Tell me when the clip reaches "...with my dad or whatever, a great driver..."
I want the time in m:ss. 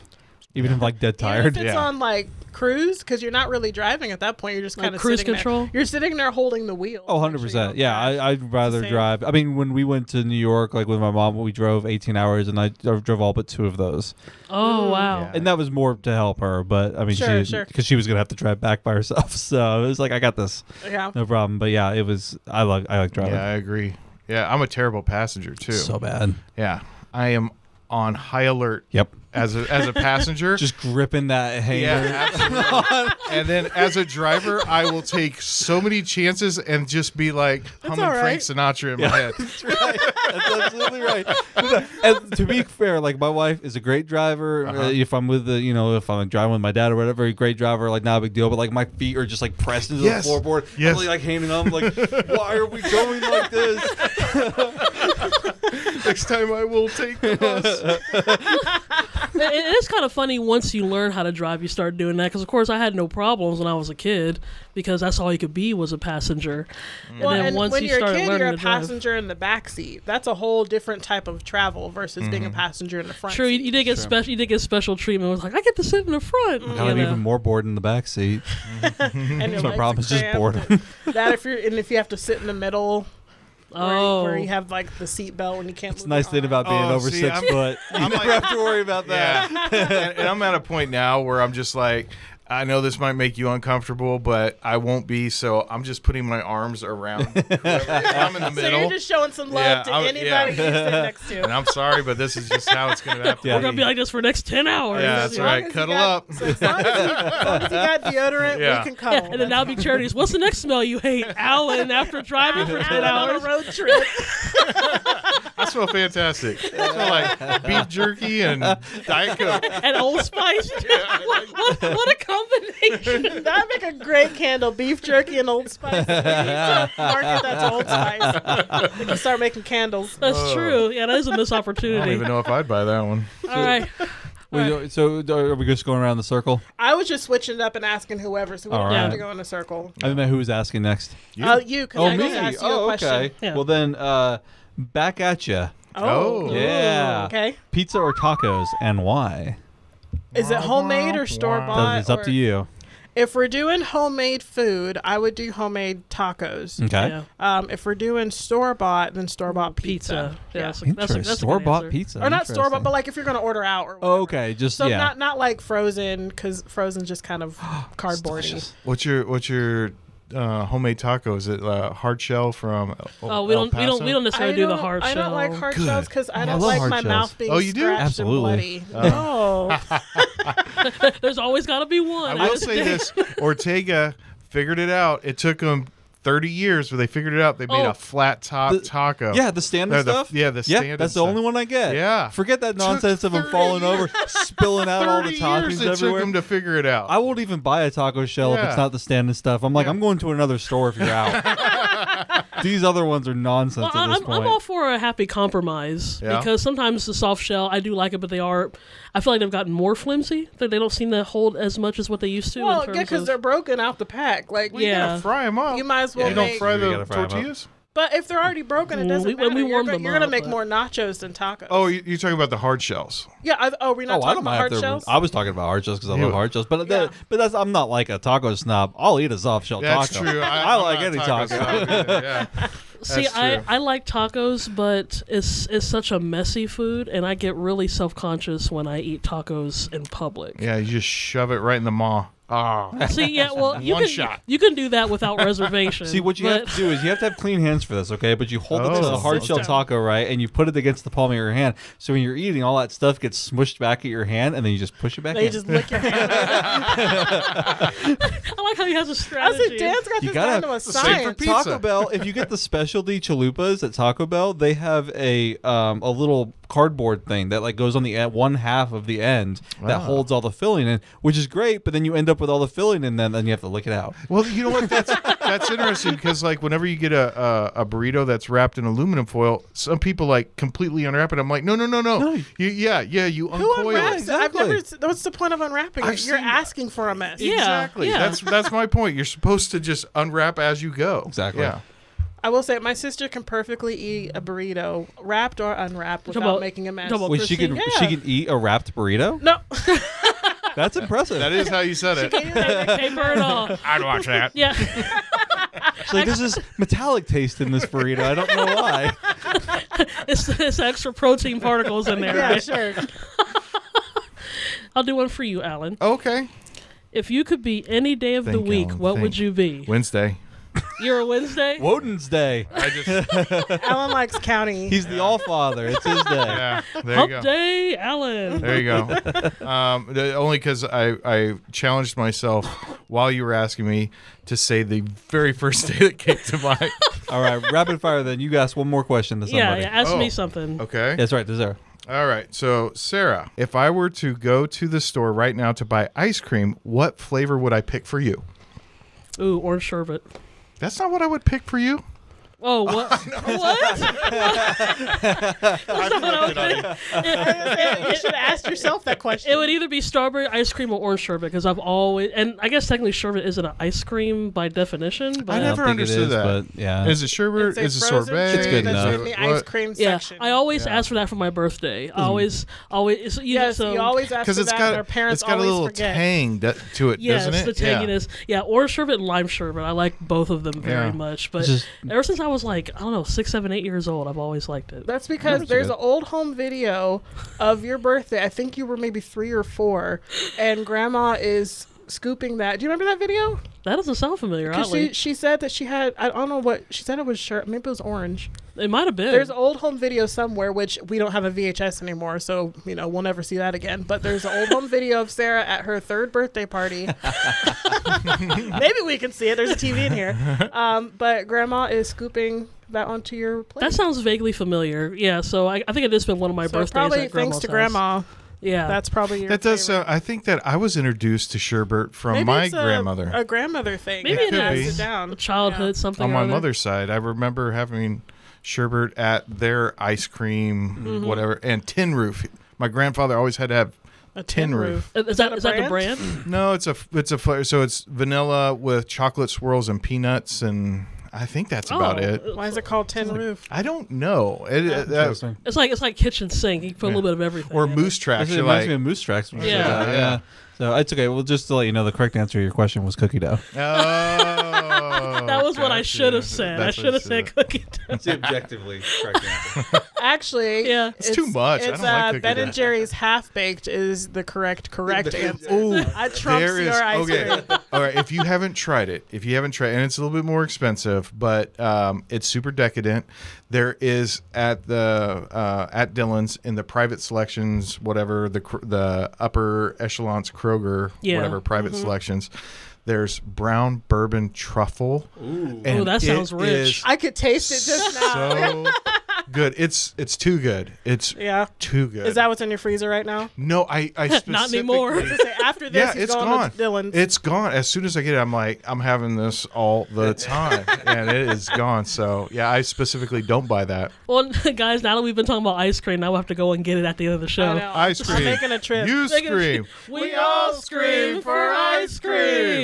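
0:46.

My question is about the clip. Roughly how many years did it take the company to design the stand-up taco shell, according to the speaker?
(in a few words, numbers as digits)
30.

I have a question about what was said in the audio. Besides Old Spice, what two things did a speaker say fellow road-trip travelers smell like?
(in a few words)
Beef jerky and Diet Coke.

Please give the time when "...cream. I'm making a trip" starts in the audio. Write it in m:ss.
8:28.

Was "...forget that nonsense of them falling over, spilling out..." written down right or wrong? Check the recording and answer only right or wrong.
right.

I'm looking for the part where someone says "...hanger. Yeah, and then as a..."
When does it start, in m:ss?
0:31.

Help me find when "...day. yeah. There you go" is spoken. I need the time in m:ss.
5:26.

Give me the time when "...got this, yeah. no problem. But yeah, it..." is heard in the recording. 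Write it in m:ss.
0:20.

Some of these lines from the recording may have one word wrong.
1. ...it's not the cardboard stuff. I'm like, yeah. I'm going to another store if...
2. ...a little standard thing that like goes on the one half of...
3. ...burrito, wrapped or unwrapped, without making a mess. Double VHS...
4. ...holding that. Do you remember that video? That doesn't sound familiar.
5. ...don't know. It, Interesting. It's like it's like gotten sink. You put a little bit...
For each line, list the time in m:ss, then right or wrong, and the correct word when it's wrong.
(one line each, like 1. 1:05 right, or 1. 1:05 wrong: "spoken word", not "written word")
1. 3:18 wrong: "standard", not "cardboard"
2. 4:26 wrong: "cardboard", not "standard"
3. 4:54 wrong: "Wait", not "VHS"
4. 6:32 wrong: "scooping", not "holding"
5. 7:23 wrong: "kitchen", not "gotten".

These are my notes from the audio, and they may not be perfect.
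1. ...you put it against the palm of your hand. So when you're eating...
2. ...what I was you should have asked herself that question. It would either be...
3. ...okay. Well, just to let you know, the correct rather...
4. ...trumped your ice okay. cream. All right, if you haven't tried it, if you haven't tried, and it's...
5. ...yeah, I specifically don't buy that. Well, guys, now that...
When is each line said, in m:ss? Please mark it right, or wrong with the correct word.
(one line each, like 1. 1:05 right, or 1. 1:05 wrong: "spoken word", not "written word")
1. 4:10 right
2. 5:56 wrong: "yourself", not "herself"
3. 7:31 wrong: "answer", not "rather"
4. 7:46 right
5. 8:22 right.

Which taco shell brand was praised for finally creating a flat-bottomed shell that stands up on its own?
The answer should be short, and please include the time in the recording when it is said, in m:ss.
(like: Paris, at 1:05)
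Ortega, at 3:03.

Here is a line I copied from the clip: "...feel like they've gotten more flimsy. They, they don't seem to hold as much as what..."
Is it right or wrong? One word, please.
right.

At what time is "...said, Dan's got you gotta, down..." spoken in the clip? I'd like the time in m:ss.
4:19.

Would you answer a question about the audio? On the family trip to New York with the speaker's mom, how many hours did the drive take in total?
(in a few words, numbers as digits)
18.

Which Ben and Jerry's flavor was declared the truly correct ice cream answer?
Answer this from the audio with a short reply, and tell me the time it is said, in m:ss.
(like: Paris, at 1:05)
Half Baked, at 7:43.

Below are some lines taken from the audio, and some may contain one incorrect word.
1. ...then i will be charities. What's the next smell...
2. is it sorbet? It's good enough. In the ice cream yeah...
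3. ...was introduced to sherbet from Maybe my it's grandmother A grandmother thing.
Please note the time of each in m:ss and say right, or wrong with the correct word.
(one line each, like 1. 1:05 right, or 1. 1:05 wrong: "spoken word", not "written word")
1. 1:49 right
2. 6:07 right
3. 7:00 right.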